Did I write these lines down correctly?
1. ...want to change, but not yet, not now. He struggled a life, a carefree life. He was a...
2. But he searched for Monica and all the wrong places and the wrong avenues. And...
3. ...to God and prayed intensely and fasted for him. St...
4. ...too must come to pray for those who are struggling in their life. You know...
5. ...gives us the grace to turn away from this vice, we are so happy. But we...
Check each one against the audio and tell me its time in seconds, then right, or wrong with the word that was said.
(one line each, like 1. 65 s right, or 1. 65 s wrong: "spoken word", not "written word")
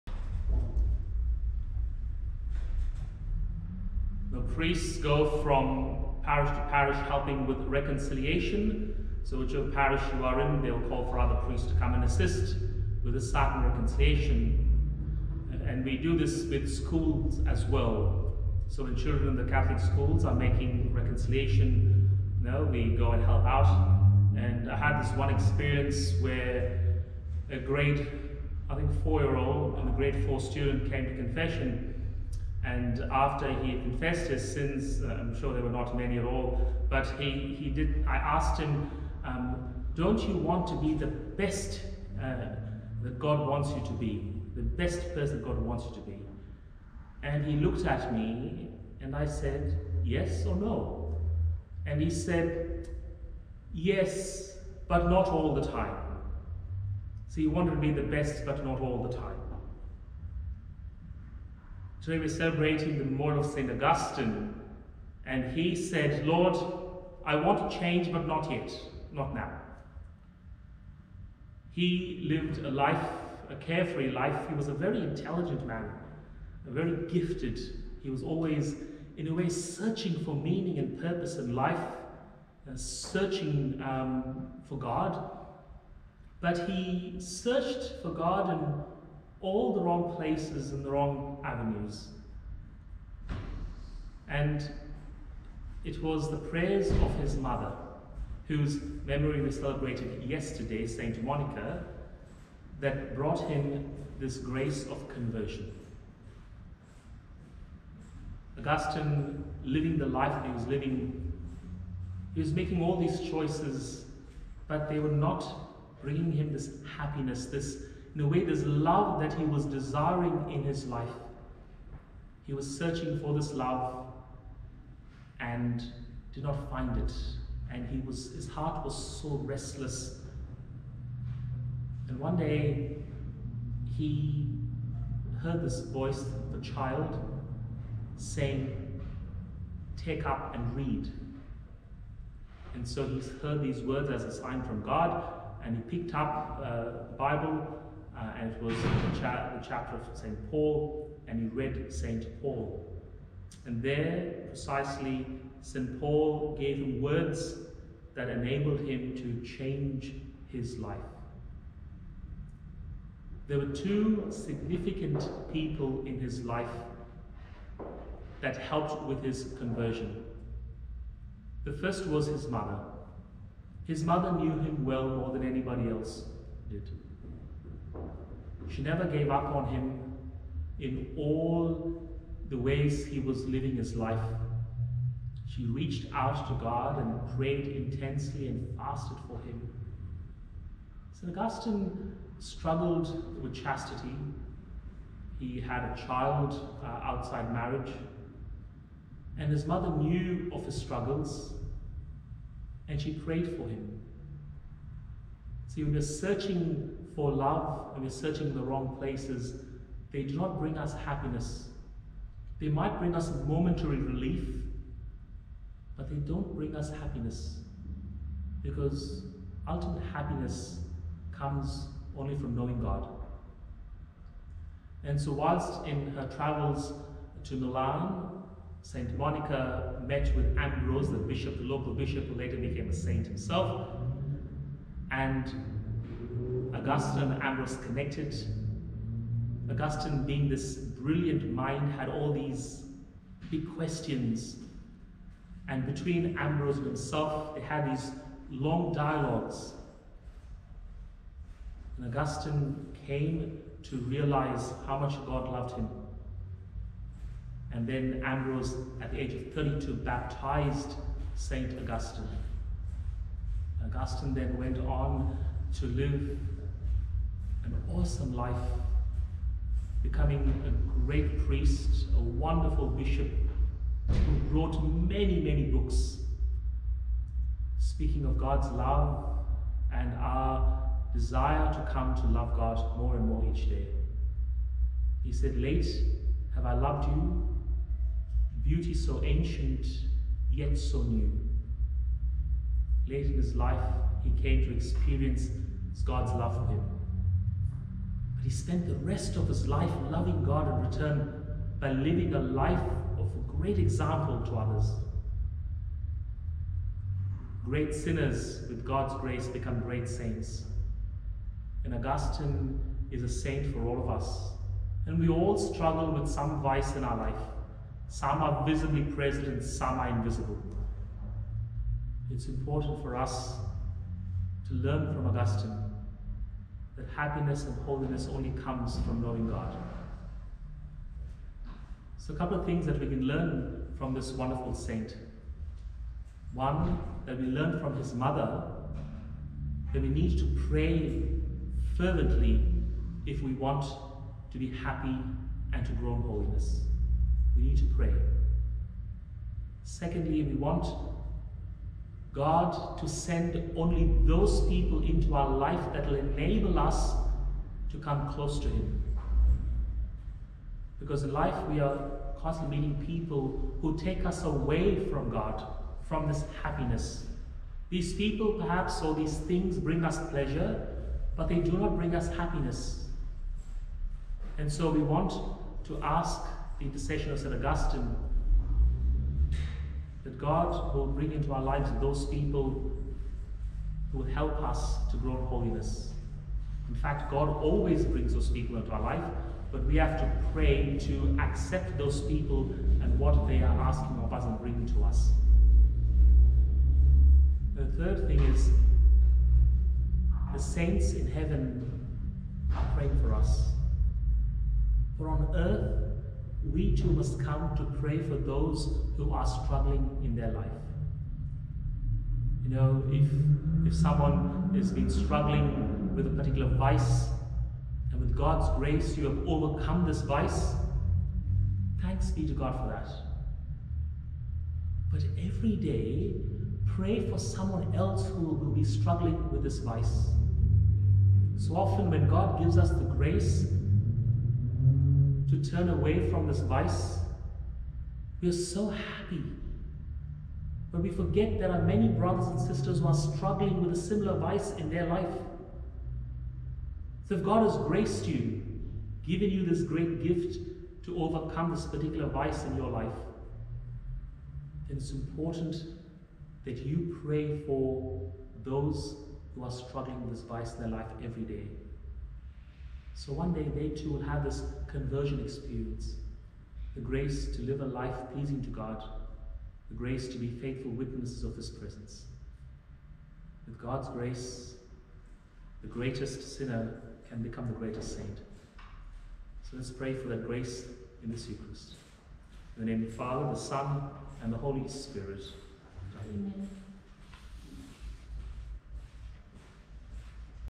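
1. 67 s wrong: "lived", not "struggled"
2. 86 s wrong: "God", not "Monica"
3. 186 s right
4. 406 s right
5. 432 s right.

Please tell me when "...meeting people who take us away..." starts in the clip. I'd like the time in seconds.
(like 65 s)
362 s.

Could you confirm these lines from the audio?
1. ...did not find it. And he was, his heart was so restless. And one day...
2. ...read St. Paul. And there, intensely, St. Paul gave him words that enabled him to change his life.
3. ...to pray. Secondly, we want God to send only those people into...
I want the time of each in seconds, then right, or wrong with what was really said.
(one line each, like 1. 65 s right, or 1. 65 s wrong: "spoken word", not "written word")
1. 126 s right
2. 151 s wrong: "precisely", not "intensely"
3. 347 s right.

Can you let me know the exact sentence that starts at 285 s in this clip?
He said, Late have I loved you, beauty so ancient, yet so new.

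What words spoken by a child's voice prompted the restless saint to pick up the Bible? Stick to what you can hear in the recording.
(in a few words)
Take up and read.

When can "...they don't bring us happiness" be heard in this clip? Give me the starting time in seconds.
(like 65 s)
216 s.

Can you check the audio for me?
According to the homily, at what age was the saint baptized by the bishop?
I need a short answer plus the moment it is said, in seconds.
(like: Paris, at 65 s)
32, at 259 s.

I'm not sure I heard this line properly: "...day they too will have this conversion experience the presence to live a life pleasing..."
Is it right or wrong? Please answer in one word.
wrong.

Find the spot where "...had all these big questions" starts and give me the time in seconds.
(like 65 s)
241 s.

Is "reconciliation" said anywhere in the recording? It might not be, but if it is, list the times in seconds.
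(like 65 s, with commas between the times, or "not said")
7 s, 13 s, 20 s.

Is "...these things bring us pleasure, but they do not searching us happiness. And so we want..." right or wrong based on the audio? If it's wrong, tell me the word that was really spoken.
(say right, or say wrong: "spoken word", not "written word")
wrong: "bring", not "searching".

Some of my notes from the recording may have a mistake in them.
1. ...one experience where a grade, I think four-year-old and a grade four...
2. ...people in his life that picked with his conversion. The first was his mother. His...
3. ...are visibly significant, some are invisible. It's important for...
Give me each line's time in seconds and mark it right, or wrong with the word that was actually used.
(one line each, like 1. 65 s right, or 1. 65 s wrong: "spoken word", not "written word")
1. 25 s right
2. 165 s wrong: "helped", not "picked"
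3. 318 s wrong: "present", not "significant".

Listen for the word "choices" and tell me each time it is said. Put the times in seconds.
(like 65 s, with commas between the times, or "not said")
113 s.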